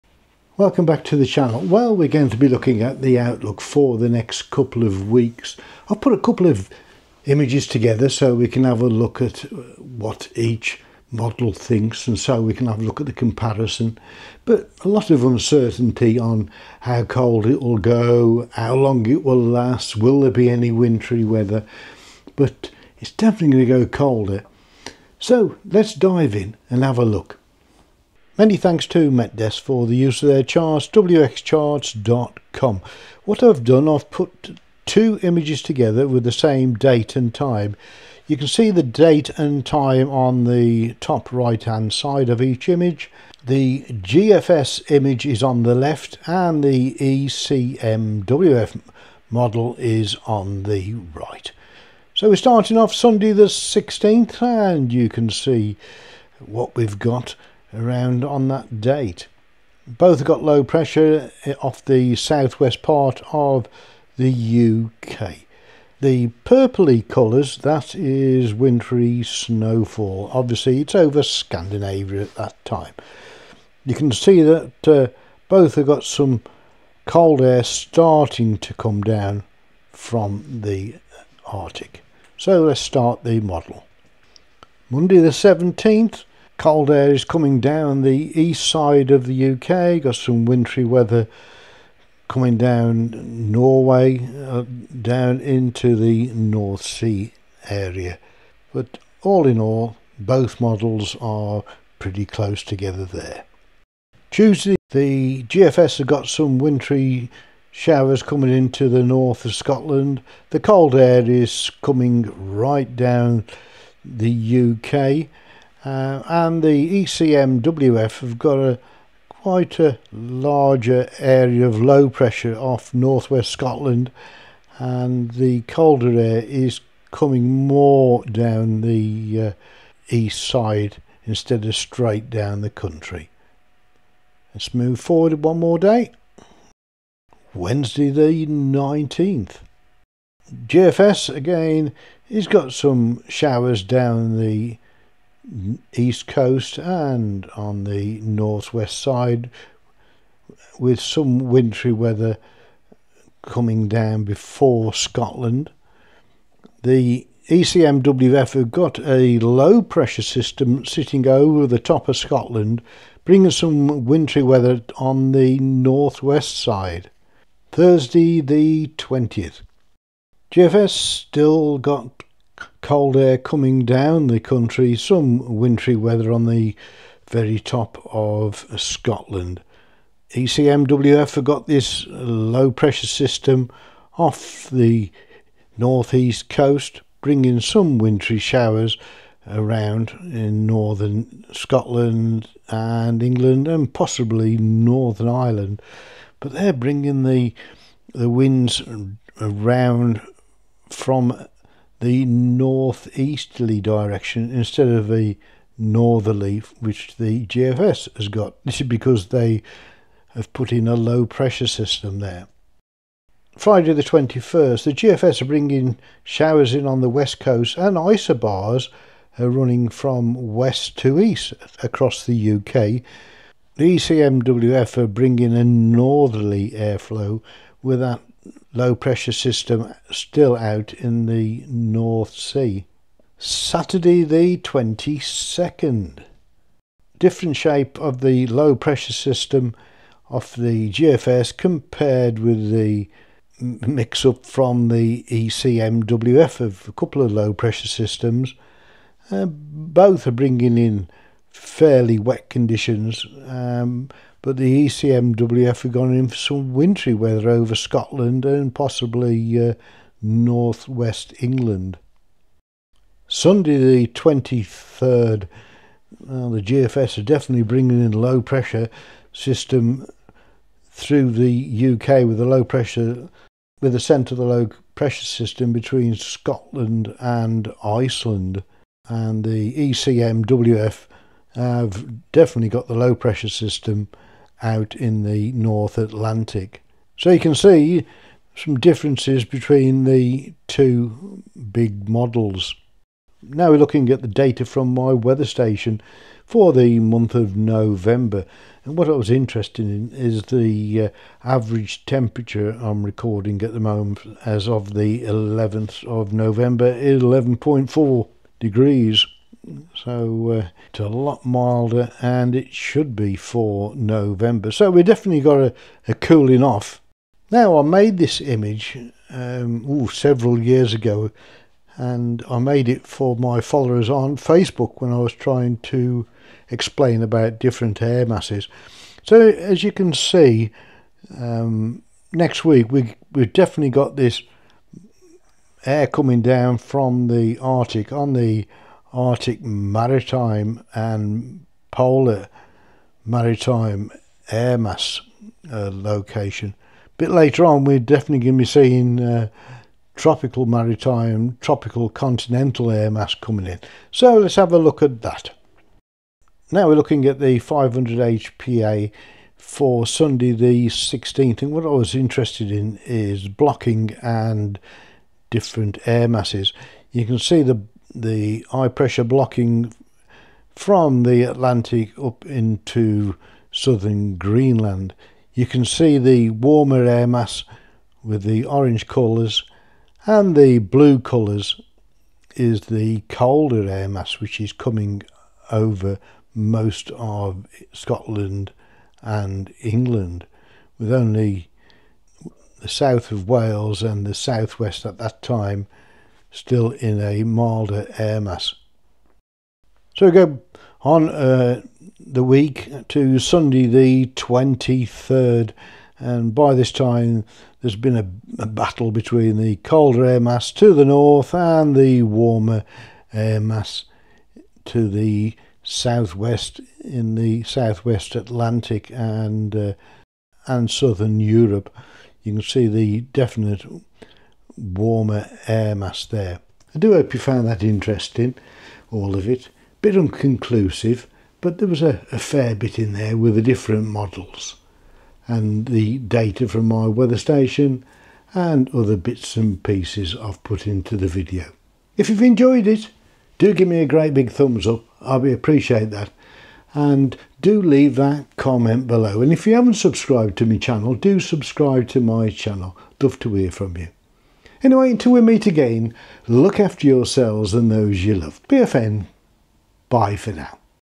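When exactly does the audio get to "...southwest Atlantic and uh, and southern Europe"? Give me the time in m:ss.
6:57.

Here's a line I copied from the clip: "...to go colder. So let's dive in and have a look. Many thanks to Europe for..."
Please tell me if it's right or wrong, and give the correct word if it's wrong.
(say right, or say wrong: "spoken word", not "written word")
wrong: "MetDesk", not "Europe".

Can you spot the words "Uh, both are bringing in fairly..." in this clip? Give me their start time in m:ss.
4:09.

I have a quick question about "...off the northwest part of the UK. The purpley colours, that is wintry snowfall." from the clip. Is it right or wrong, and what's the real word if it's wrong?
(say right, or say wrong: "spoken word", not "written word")
wrong: "southwest", not "northwest".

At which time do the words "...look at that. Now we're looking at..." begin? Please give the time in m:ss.
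5:54.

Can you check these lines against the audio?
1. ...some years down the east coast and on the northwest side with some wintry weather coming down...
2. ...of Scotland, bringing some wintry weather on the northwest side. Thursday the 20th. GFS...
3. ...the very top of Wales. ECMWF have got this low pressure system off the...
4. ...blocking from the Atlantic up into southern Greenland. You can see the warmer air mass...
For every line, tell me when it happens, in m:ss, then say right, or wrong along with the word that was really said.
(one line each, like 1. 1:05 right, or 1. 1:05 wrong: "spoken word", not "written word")
1. 2:22 wrong: "showers", not "years"
2. 2:42 right
3. 2:56 wrong: "Scotland", not "Wales"
4. 6:09 right.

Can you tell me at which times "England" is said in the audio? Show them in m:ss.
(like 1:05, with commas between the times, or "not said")
3:13, 4:21, 6:29.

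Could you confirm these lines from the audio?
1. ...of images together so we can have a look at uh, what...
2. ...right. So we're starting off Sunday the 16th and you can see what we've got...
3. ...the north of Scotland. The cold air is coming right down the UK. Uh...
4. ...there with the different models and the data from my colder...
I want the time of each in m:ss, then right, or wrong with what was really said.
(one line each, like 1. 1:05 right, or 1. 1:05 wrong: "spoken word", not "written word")
1. 0:06 right
2. 0:51 right
3. 1:48 right
4. 7:13 wrong: "weather", not "colder".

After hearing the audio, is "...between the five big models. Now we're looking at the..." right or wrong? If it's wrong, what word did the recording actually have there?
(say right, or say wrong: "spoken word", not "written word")
wrong: "two", not "five".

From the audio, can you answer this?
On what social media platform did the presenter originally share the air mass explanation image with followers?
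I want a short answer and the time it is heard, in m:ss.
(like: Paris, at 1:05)
Facebook, at 5:24.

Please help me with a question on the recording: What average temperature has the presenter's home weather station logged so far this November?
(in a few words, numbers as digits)
11.4 degrees.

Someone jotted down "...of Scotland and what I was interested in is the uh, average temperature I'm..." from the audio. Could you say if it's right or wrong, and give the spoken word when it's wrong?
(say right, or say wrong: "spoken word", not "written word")
wrong: "November", not "Scotland".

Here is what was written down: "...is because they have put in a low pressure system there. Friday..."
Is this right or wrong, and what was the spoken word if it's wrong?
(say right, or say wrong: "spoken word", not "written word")
right.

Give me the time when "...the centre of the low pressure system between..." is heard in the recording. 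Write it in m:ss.
4:33.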